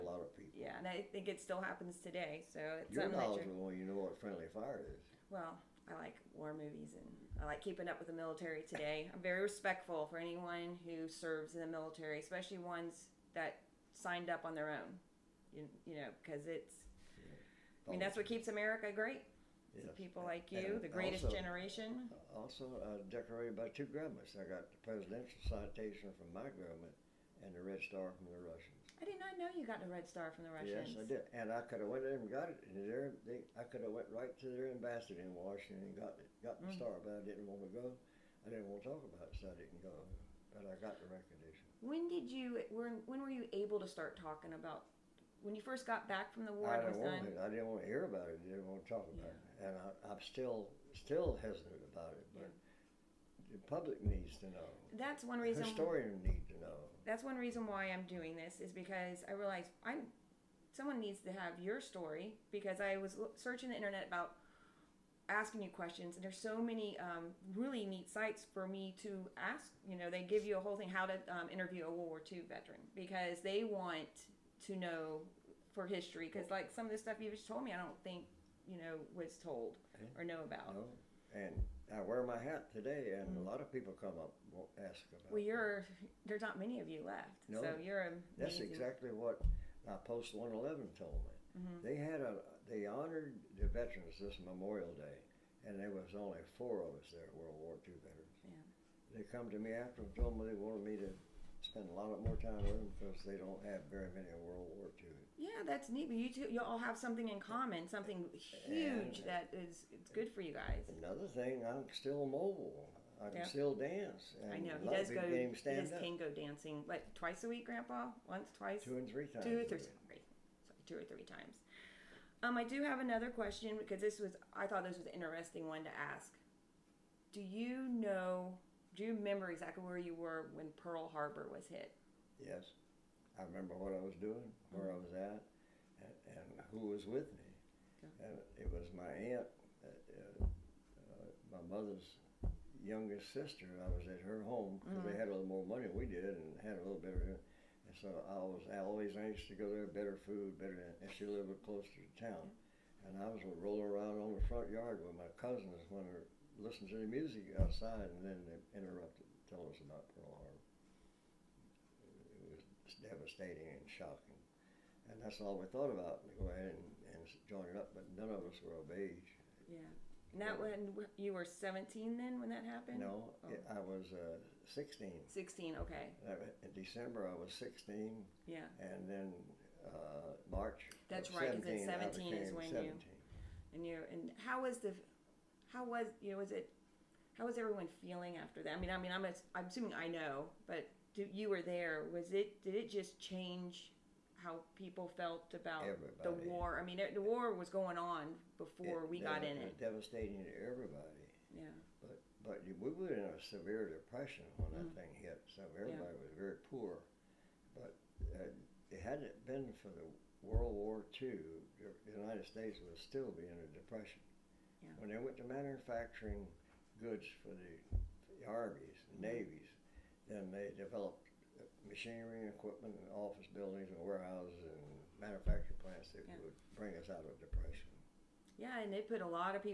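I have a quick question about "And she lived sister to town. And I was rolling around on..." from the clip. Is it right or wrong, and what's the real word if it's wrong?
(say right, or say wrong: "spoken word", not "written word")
wrong: "closer", not "sister".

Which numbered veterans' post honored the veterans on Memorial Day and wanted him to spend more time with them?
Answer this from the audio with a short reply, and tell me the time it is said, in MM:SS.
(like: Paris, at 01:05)
Post 111, at 01:30.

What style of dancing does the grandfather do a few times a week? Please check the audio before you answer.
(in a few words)
Tango.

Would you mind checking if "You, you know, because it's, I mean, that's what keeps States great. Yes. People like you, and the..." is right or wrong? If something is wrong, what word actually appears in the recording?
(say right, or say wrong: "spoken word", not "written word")
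wrong: "America", not "States".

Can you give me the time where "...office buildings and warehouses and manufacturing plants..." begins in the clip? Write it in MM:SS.
03:43.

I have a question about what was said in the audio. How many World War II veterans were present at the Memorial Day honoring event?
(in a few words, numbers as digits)
4.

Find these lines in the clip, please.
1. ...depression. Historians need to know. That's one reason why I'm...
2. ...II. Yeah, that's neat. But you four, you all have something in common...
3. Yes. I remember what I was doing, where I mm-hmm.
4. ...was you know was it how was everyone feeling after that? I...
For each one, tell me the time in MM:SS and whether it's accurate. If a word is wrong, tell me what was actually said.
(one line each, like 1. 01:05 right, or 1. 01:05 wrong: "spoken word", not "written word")
1. 00:55 wrong: "reason", not "depression"
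2. 01:44 wrong: "two", not "four"
3. 02:12 right
4. 03:05 right.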